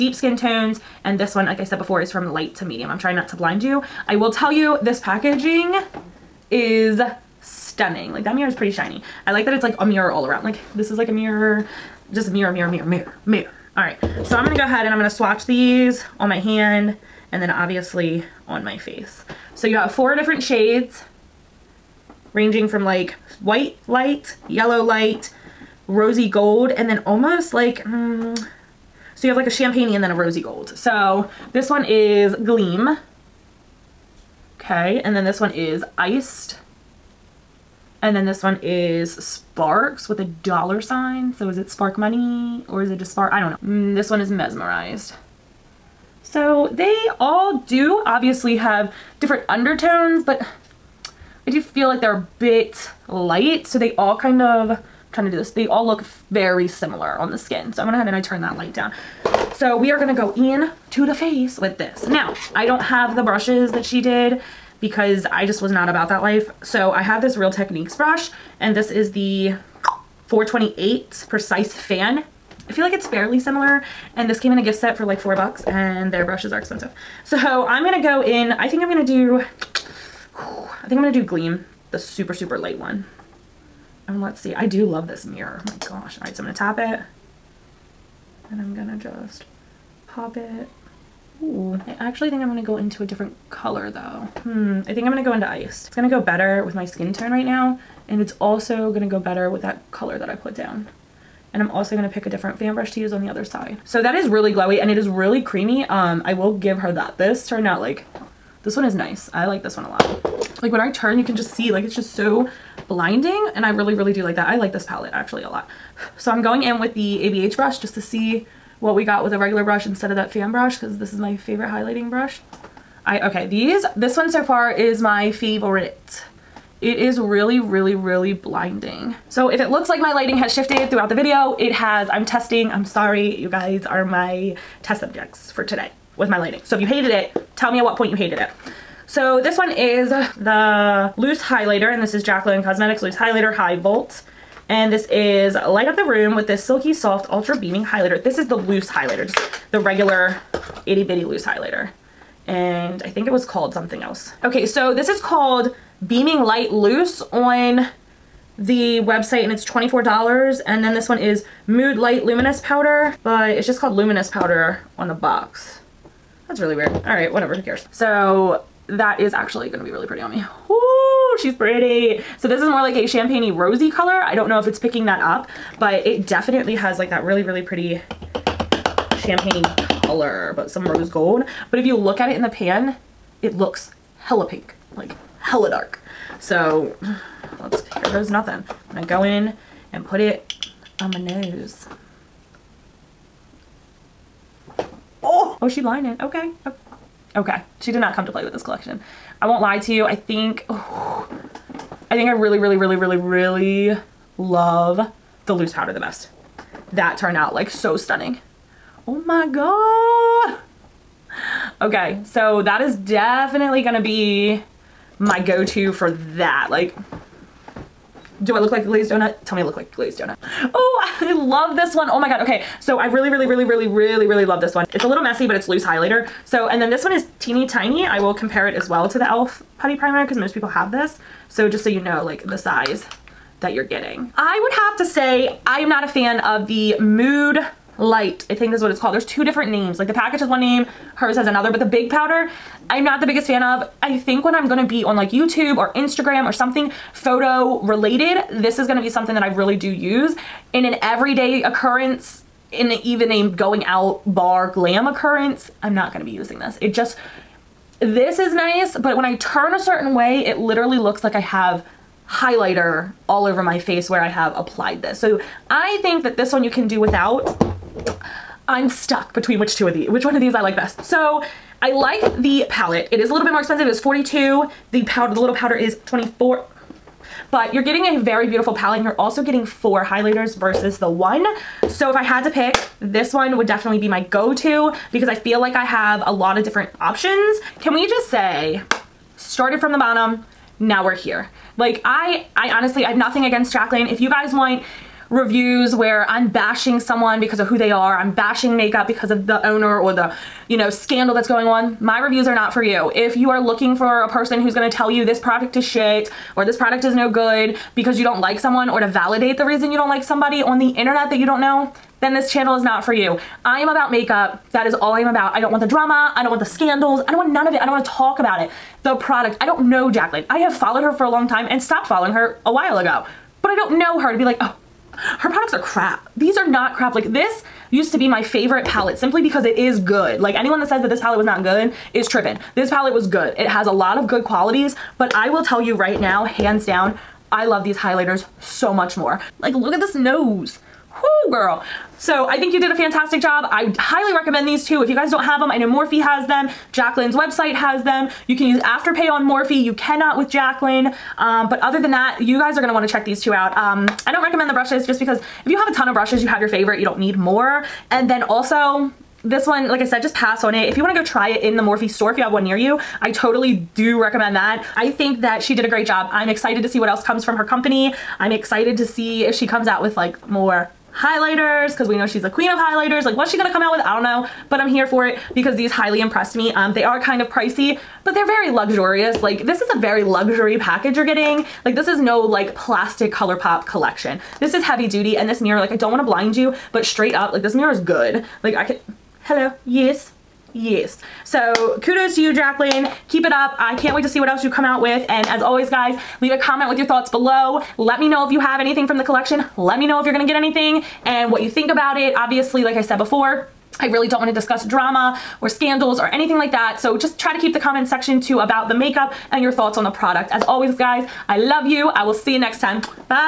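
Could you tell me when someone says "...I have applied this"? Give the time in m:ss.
4:24.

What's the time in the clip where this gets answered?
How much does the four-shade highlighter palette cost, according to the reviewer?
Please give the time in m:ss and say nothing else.
4:33.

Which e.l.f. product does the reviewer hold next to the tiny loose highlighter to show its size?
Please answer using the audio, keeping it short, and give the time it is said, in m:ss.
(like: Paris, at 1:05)
e.l.f. putty primer, at 3:49.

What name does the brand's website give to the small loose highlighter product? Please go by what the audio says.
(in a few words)
Beaming Light Loose.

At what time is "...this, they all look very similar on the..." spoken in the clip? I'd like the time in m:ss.
0:55.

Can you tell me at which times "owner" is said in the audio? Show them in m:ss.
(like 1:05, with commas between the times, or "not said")
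4:59.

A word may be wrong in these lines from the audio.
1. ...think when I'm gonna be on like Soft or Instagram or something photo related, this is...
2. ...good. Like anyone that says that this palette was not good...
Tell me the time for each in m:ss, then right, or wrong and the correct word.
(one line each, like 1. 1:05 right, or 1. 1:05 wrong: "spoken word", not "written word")
1. 4:04 wrong: "YouTube", not "Soft"
2. 5:29 right.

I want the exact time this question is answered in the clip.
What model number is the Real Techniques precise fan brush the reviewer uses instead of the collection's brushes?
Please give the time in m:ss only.
1:10.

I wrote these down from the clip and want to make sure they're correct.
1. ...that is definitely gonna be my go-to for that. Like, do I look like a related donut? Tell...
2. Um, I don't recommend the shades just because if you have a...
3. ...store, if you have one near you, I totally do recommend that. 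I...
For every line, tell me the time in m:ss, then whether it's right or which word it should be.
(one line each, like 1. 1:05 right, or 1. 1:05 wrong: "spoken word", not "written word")
1. 3:32 wrong: "glazed", not "related"
2. 5:53 wrong: "brushes", not "shades"
3. 6:02 right.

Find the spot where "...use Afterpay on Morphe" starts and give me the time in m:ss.
5:48.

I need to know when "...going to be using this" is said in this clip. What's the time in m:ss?
4:16.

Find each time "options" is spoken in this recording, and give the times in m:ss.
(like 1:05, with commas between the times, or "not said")
4:46.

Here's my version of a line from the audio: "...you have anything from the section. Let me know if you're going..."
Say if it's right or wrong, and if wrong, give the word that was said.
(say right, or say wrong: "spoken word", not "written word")
wrong: "collection", not "section".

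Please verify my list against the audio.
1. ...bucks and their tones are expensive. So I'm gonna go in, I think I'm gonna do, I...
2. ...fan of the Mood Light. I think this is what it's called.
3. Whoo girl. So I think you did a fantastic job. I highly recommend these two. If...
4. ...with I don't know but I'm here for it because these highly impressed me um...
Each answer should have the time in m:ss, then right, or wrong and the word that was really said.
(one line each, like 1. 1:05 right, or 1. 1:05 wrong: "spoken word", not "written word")
1. 1:15 wrong: "brushes", not "tones"
2. 3:56 right
3. 5:41 right
4. 6:13 right.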